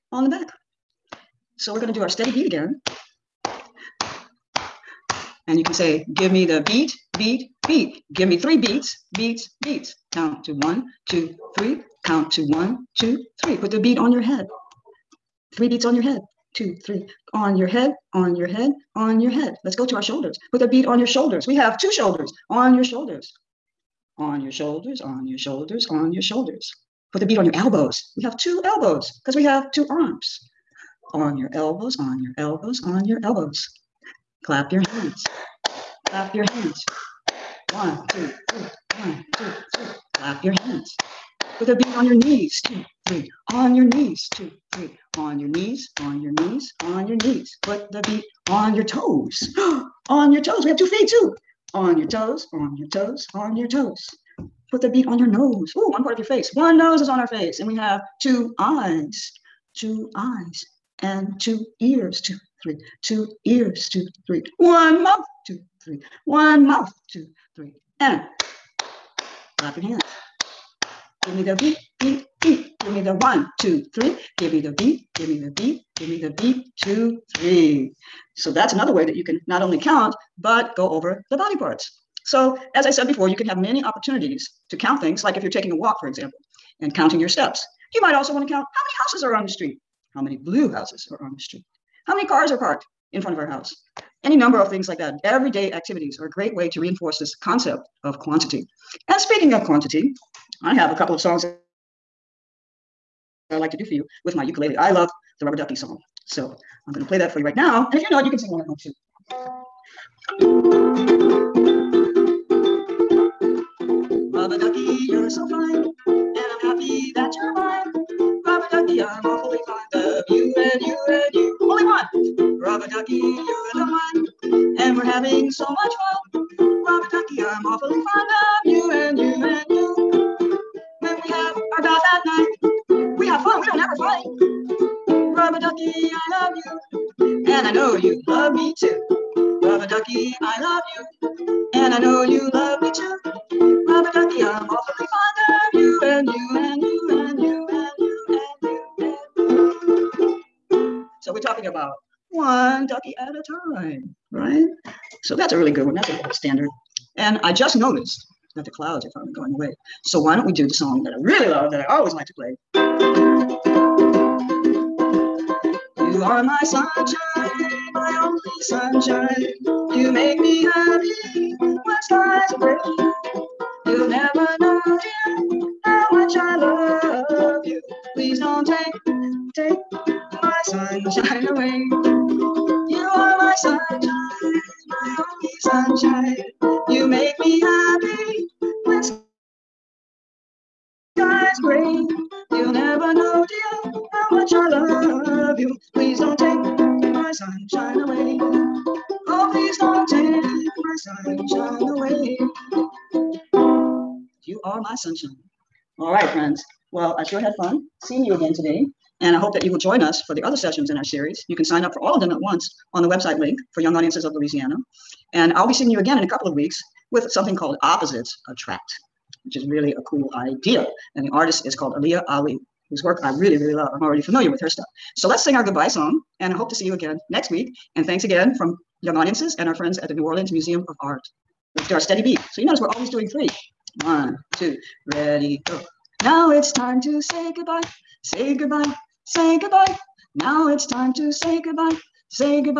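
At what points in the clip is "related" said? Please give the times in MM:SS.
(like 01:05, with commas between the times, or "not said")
not said.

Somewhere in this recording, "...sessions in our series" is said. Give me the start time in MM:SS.
03:30.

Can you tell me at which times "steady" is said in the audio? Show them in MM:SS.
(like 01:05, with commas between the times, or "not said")
00:02, 03:51.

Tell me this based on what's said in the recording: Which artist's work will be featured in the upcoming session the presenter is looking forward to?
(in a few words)
Aliyah Ali.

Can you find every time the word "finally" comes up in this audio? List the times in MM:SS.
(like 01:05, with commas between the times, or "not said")
02:39.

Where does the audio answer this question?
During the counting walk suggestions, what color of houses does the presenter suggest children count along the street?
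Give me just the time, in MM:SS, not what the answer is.
01:30.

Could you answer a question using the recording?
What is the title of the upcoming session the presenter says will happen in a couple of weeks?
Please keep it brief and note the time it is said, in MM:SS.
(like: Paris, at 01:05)
Opposites Attract, at 03:37.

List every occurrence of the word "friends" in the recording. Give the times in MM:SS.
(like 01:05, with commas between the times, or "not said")
03:26, 03:49.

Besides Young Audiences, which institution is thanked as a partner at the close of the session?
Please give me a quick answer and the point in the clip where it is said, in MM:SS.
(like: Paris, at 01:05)
New Orleans Museum of Art, at 03:50.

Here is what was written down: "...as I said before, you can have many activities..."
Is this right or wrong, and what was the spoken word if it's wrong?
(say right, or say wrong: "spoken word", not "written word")
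wrong: "opportunities", not "activities".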